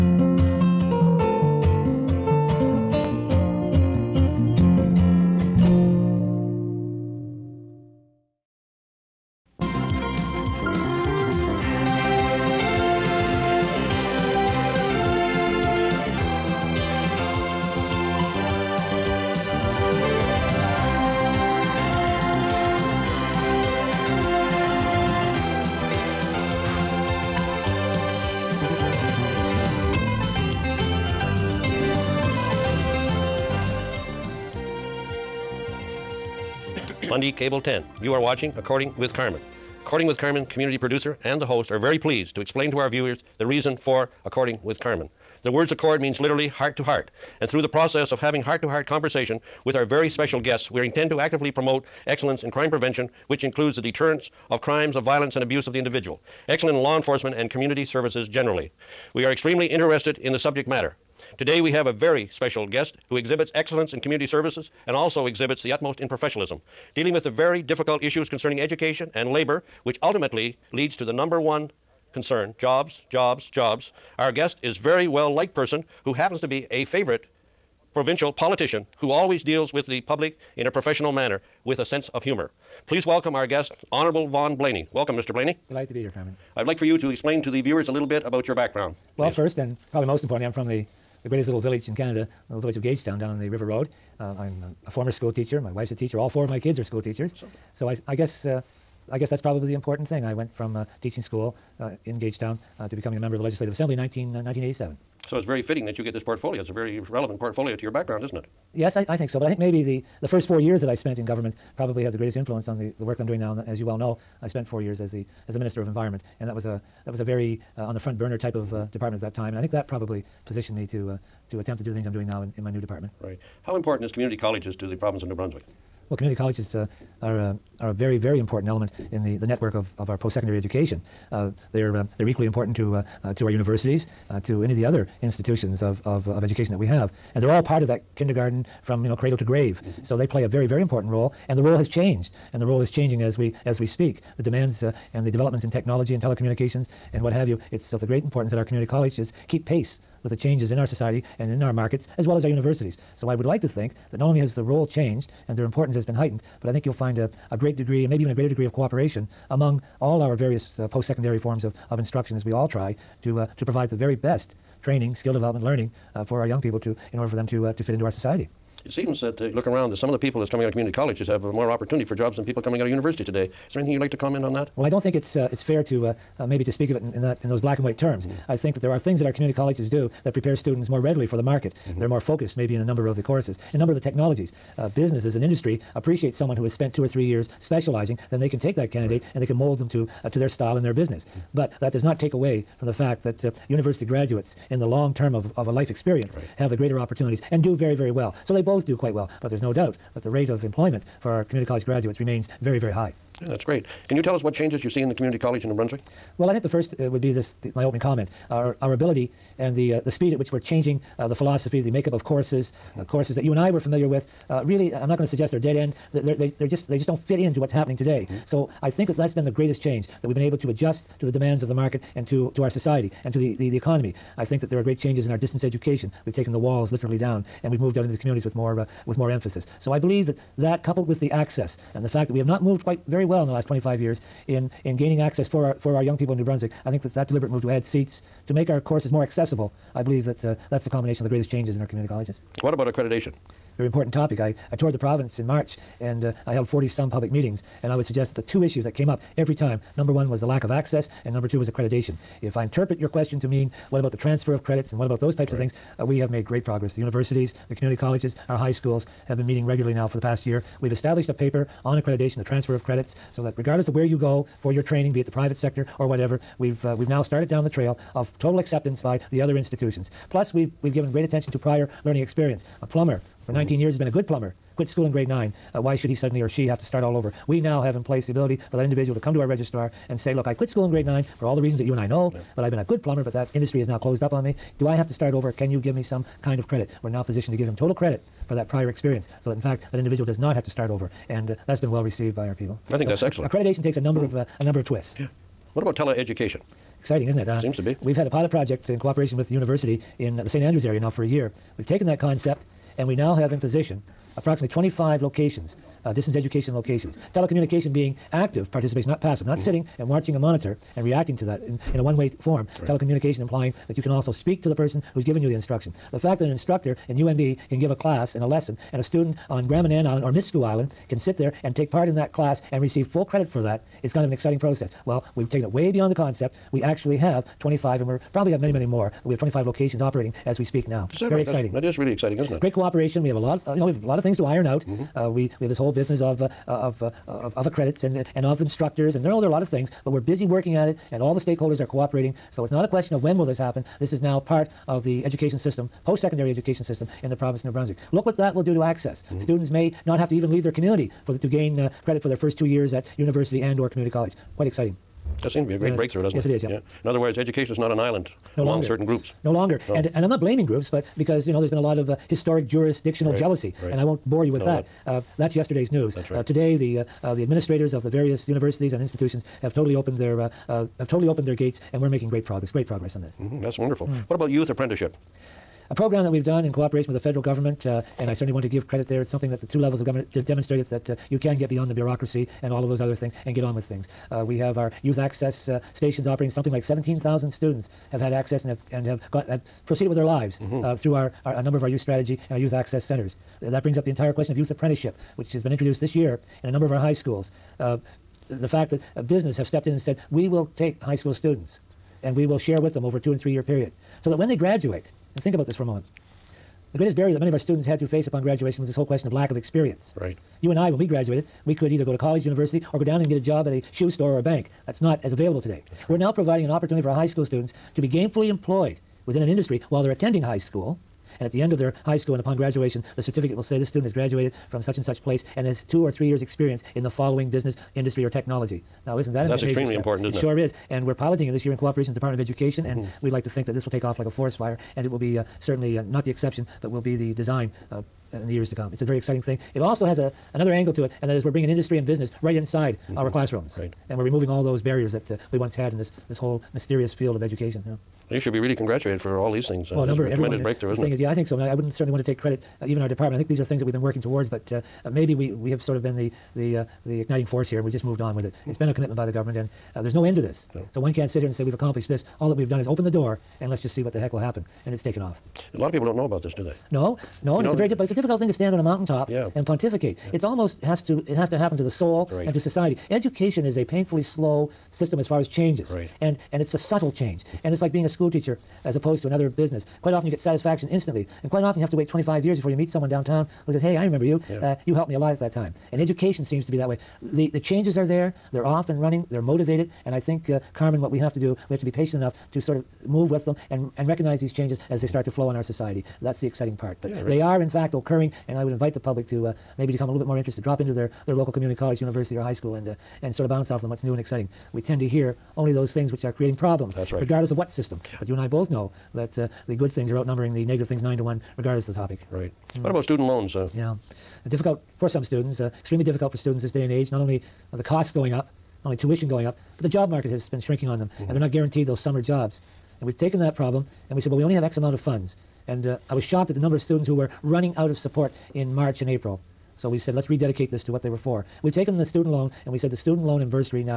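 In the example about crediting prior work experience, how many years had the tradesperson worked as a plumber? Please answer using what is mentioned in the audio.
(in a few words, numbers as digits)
19.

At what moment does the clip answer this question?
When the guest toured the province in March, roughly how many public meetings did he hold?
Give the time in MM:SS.
04:06.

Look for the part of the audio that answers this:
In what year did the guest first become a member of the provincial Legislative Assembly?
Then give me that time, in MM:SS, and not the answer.
01:44.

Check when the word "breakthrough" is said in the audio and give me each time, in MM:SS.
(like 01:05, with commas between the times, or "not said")
05:55, 07:30.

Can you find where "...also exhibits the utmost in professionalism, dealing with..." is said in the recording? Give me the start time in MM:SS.
01:04.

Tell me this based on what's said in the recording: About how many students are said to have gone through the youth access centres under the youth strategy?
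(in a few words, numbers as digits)
17,000.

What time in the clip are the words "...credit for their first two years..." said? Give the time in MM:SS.
05:52.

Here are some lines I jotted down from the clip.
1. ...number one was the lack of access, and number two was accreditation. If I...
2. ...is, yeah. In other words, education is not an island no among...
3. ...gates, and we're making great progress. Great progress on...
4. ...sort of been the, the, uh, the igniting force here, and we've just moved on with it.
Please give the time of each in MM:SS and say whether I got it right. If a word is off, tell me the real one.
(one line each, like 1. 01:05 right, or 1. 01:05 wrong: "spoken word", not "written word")
1. 04:09 right
2. 05:56 right
3. 06:11 right
4. 07:35 right.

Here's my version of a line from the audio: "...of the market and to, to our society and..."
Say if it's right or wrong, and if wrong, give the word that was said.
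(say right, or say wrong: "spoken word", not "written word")
right.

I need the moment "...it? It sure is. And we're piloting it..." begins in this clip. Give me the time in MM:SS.
07:10.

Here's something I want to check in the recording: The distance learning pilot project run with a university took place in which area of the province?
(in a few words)
St. Andrews.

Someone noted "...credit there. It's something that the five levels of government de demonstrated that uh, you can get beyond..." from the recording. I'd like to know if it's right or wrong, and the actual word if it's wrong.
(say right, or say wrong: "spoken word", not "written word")
wrong: "two", not "five".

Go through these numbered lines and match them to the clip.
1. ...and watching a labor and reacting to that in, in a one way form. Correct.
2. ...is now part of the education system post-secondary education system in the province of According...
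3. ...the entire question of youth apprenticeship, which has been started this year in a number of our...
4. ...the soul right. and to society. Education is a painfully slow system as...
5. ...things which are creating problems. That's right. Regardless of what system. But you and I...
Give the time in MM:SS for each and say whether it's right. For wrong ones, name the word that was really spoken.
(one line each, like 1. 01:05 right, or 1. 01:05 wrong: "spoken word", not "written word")
1. 05:09 wrong: "monitor", not "labor"
2. 05:44 wrong: "New", not "According"
3. 06:34 wrong: "introduced", not "started"
4. 07:51 right
5. 08:25 right.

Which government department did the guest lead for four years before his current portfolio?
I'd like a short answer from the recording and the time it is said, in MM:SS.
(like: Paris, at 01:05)
Environment, at 01:55.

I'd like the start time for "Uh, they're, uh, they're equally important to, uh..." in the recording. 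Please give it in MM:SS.
02:11.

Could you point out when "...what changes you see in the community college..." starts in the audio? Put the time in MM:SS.
03:24.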